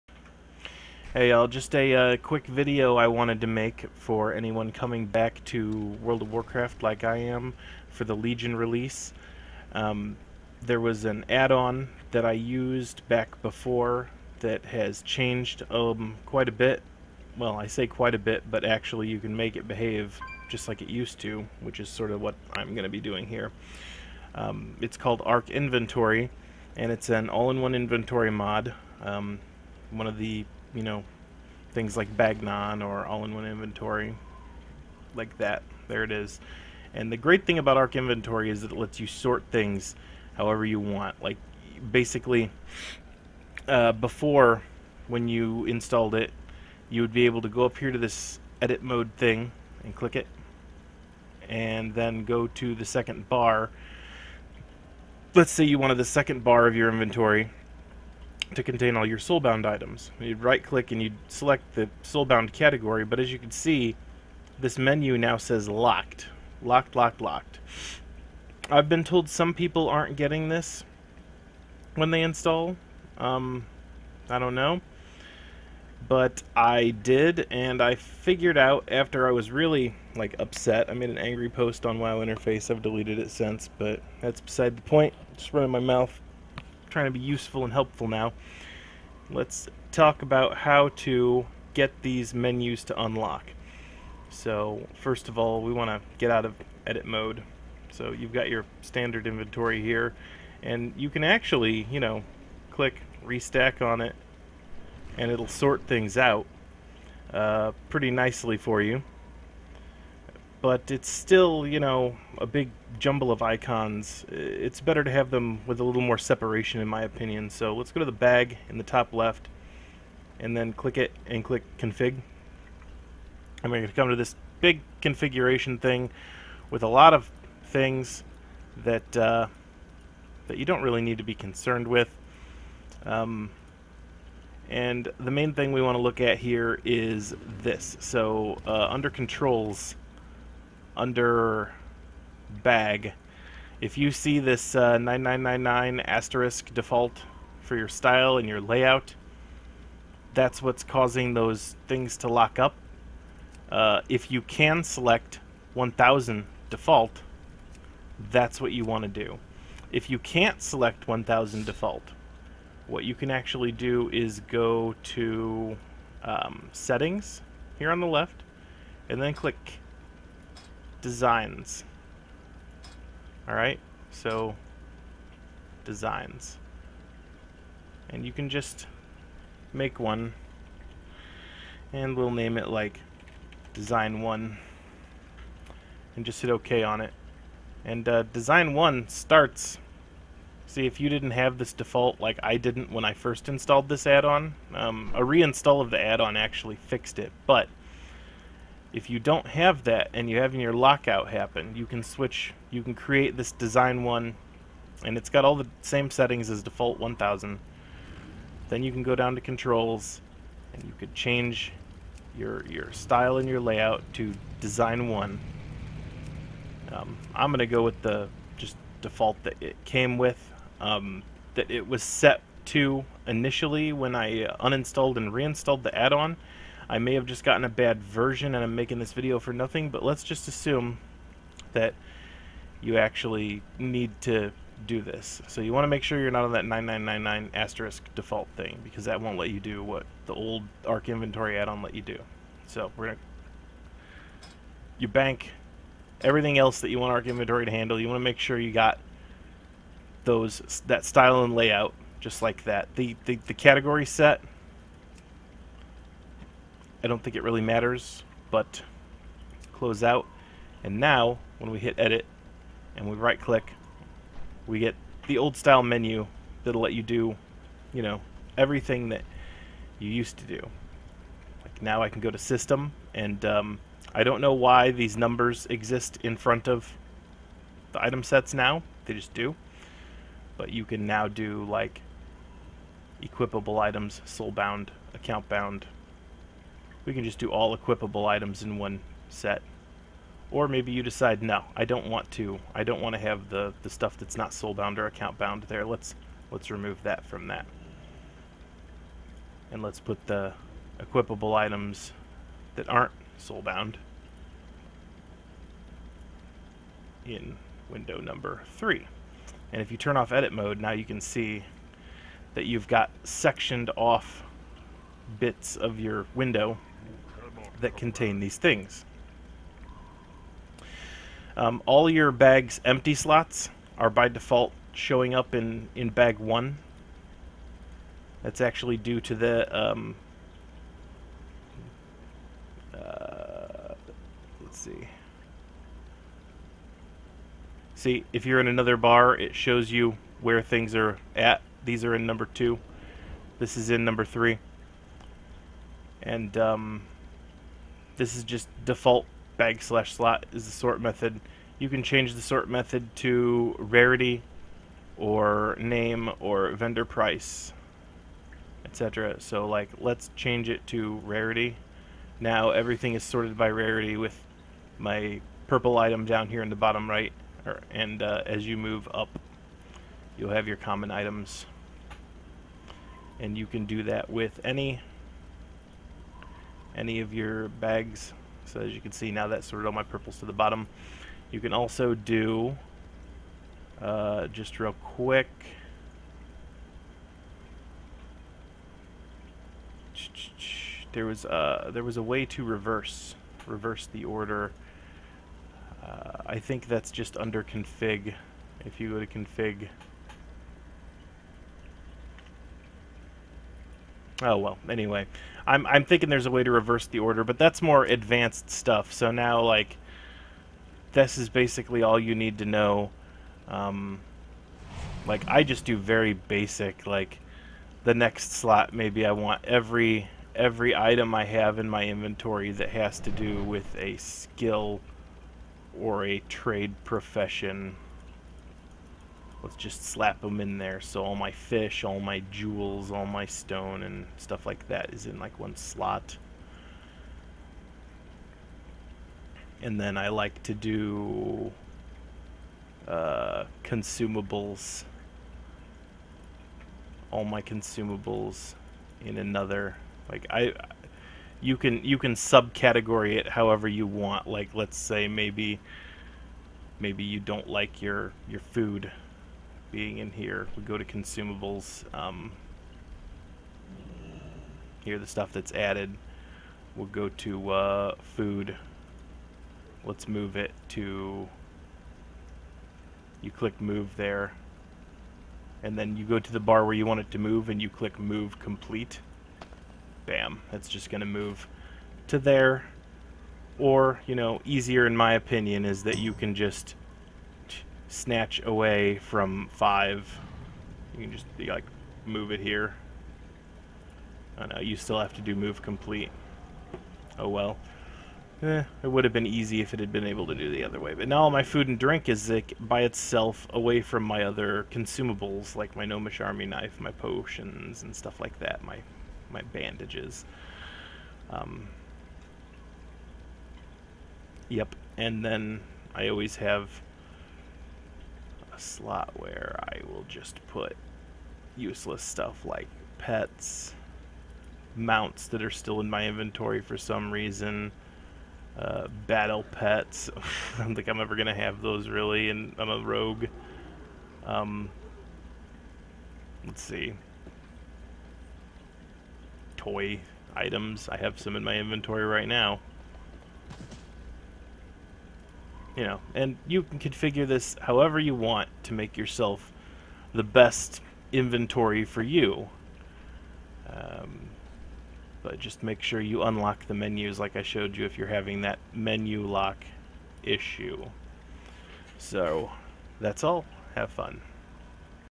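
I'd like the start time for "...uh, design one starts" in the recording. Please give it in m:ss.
3:08.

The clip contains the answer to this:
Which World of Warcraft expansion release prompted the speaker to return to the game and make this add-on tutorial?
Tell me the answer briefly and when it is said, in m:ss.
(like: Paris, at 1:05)
Legion, at 0:08.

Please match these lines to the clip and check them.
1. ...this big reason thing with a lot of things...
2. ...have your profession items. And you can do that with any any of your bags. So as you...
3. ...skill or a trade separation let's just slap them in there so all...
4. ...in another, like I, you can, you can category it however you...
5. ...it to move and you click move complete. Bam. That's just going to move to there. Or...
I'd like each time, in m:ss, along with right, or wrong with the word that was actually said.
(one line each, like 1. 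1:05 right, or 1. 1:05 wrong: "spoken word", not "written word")
1. 2:04 wrong: "configuration", not "reason"
2. 6:10 wrong: "common", not "profession"
3. 7:04 wrong: "profession", not "separation"
4. 7:29 wrong: "subcategory", not "category"
5. 7:57 right.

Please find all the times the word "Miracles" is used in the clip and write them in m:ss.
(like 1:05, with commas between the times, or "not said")
not said.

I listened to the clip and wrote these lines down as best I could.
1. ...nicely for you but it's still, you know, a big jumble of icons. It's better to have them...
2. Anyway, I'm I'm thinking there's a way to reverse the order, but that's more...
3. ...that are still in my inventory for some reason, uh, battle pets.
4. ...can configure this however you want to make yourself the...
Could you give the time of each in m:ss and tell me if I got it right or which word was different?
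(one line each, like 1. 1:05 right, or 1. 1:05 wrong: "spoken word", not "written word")
1. 1:48 right
2. 6:44 right
3. 8:45 right
4. 9:06 right.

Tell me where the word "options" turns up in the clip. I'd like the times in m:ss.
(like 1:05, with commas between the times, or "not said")
not said.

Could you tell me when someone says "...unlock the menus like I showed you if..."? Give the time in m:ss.
9:16.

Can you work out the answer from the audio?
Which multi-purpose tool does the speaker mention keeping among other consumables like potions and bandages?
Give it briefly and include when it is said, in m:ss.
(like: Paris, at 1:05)
Gnomish Army Knife, at 8:26.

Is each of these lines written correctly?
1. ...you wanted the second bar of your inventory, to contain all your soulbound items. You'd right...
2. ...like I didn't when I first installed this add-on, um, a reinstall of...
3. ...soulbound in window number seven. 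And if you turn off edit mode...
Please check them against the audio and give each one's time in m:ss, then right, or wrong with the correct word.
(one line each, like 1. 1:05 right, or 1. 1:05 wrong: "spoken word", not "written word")
1. 0:55 right
2. 3:12 right
3. 5:03 wrong: "three", not "seven".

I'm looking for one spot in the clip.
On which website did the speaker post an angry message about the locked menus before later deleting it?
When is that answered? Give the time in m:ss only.
1:21.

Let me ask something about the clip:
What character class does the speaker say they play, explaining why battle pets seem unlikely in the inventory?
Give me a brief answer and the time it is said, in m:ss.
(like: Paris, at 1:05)
rogue, at 8:52.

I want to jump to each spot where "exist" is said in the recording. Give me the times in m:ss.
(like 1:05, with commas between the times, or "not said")
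4:35.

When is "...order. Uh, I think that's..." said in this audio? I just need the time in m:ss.
6:34.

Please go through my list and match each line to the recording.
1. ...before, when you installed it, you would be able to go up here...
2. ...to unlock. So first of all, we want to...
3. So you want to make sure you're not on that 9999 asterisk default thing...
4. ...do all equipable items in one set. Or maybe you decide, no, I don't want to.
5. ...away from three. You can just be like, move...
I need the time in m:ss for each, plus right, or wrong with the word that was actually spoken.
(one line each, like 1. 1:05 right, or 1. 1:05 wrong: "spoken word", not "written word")
1. 0:43 right
2. 1:32 right
3. 3:55 right
4. 4:47 right
5. 8:08 wrong: "five", not "three".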